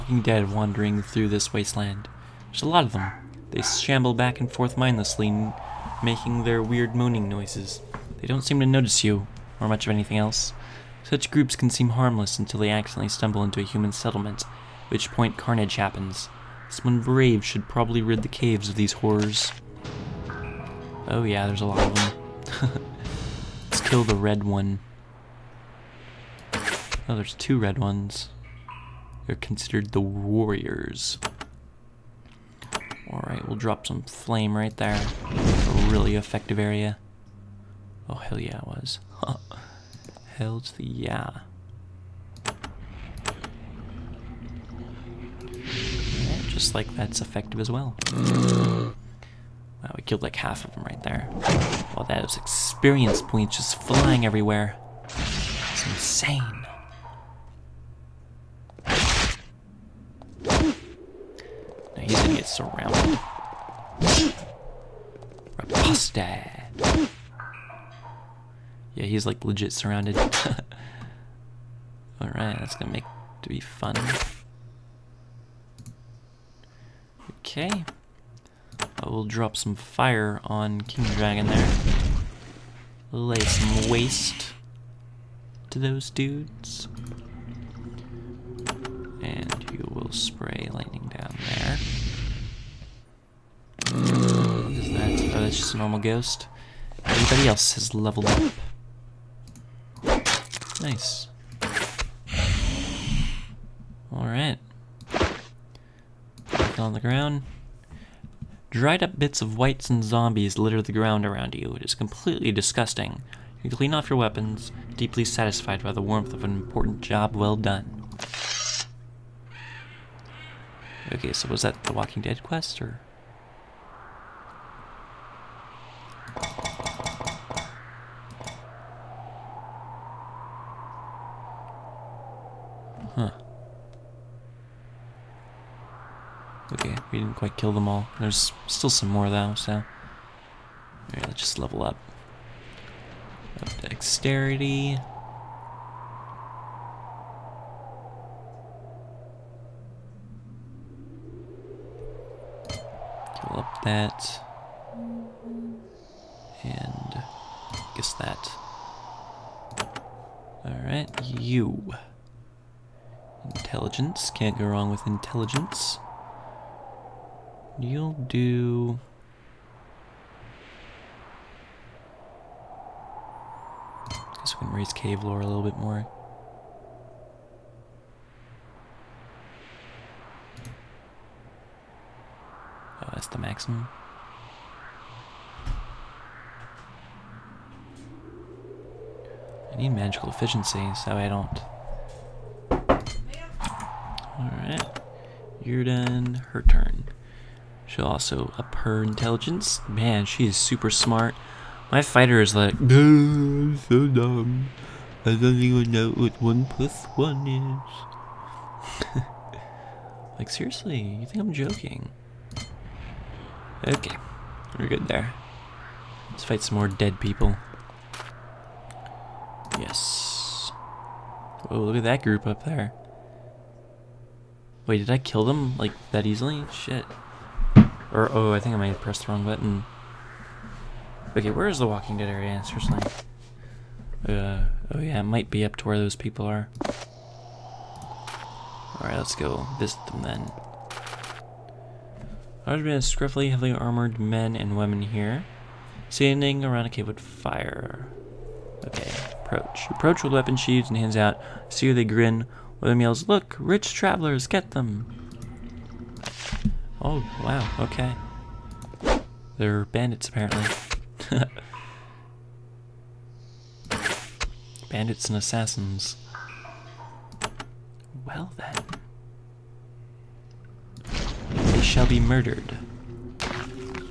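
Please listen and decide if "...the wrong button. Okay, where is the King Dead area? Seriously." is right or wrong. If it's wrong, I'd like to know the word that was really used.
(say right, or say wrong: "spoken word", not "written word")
wrong: "Walking", not "King".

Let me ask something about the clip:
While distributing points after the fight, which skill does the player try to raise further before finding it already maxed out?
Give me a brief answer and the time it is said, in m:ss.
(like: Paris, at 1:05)
cave lore, at 2:54.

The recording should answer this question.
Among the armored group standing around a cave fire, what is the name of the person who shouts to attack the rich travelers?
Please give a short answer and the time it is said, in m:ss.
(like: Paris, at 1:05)
William, at 4:12.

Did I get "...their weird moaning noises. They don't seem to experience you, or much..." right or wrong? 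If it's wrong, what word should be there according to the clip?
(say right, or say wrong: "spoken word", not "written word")
wrong: "notice", not "experience".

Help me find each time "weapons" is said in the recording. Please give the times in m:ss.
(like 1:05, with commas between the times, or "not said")
1:54, 4:10.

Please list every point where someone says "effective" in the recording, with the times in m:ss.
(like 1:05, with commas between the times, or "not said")
0:36, 0:47.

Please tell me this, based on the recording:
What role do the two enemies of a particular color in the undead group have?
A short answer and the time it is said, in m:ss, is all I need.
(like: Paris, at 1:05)
warriors, at 0:29.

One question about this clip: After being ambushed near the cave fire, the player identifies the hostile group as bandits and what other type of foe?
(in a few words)
assassins.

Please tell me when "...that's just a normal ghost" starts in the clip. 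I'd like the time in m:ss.
1:35.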